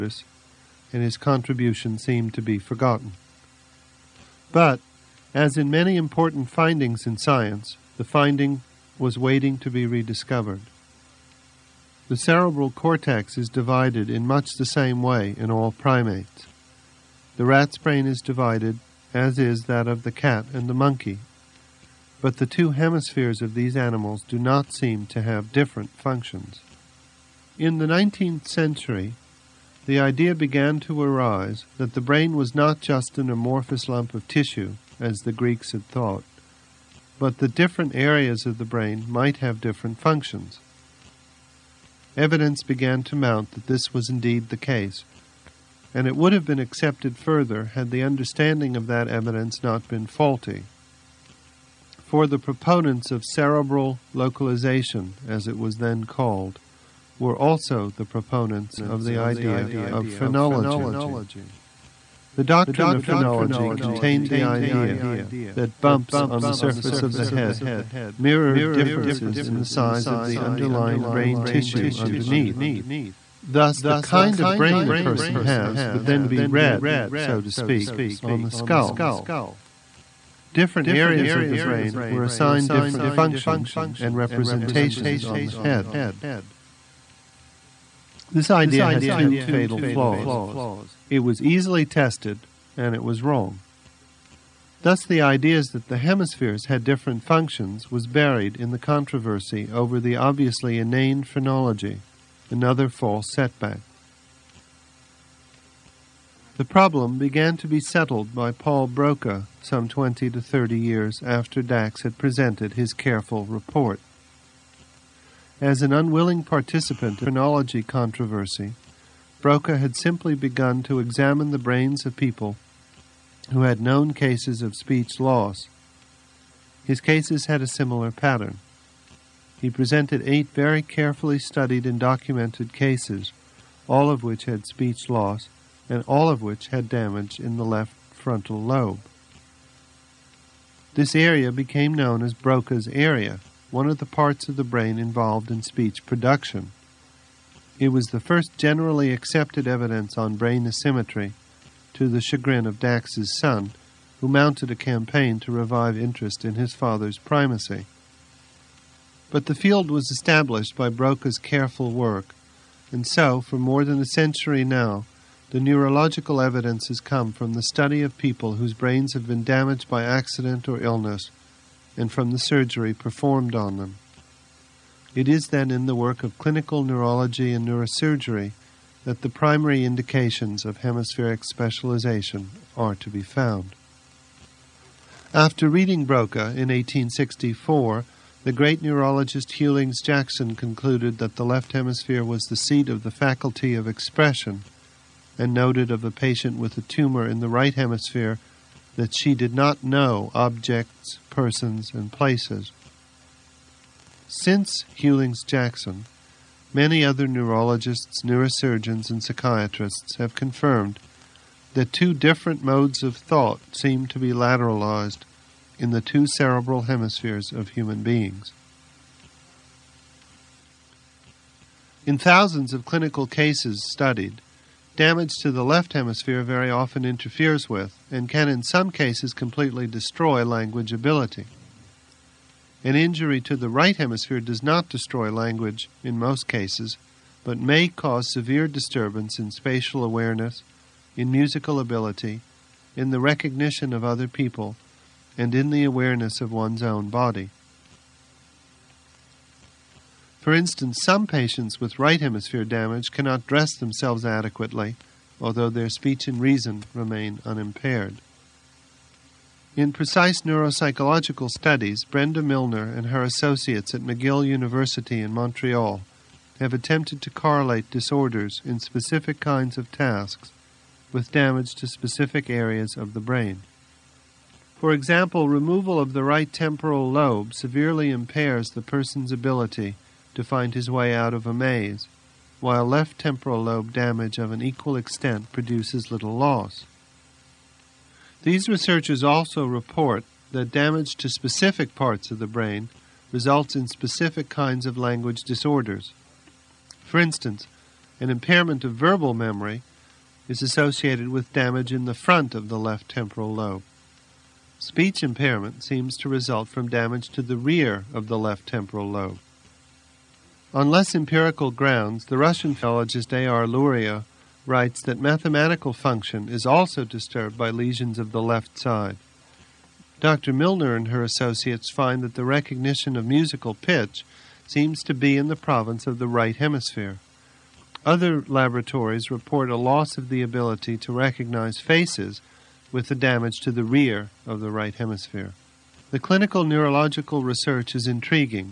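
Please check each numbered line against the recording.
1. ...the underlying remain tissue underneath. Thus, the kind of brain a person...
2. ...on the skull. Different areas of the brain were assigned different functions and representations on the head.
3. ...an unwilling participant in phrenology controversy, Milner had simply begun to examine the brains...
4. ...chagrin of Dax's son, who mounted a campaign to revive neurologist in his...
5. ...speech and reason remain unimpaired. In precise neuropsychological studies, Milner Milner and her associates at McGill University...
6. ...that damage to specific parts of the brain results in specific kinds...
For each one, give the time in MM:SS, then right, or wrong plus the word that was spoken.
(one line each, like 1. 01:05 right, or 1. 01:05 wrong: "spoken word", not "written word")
1. 01:10 wrong: "brain", not "remain"
2. 01:18 right
3. 01:55 wrong: "Broca", not "Milner"
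4. 02:32 wrong: "interest", not "neurologist"
5. 04:15 wrong: "Brenda", not "Milner"
6. 04:50 right.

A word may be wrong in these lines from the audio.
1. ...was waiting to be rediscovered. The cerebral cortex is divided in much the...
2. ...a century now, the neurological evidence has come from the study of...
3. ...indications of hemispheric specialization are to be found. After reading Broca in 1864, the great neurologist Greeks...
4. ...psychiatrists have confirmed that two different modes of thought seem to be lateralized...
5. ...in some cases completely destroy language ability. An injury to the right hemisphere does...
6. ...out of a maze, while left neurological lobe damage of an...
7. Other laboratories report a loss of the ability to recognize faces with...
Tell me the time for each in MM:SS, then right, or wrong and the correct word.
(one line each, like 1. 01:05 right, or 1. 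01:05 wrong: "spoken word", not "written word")
1. 00:08 right
2. 02:43 right
3. 02:59 wrong: "Hughlings", not "Greeks"
4. 03:29 right
5. 03:48 right
6. 04:41 wrong: "temporal", not "neurological"
7. 05:28 right.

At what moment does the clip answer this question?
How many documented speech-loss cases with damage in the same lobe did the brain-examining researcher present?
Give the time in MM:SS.
02:10.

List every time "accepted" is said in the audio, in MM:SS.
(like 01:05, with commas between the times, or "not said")
00:46, 02:29.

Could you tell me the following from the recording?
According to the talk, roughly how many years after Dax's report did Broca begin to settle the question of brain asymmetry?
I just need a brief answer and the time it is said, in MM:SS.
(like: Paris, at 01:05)
20 to 30, at 01:49.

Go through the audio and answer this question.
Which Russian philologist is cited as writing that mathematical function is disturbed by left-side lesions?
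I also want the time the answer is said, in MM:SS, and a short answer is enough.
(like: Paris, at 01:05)
A.R. Luria, at 05:13.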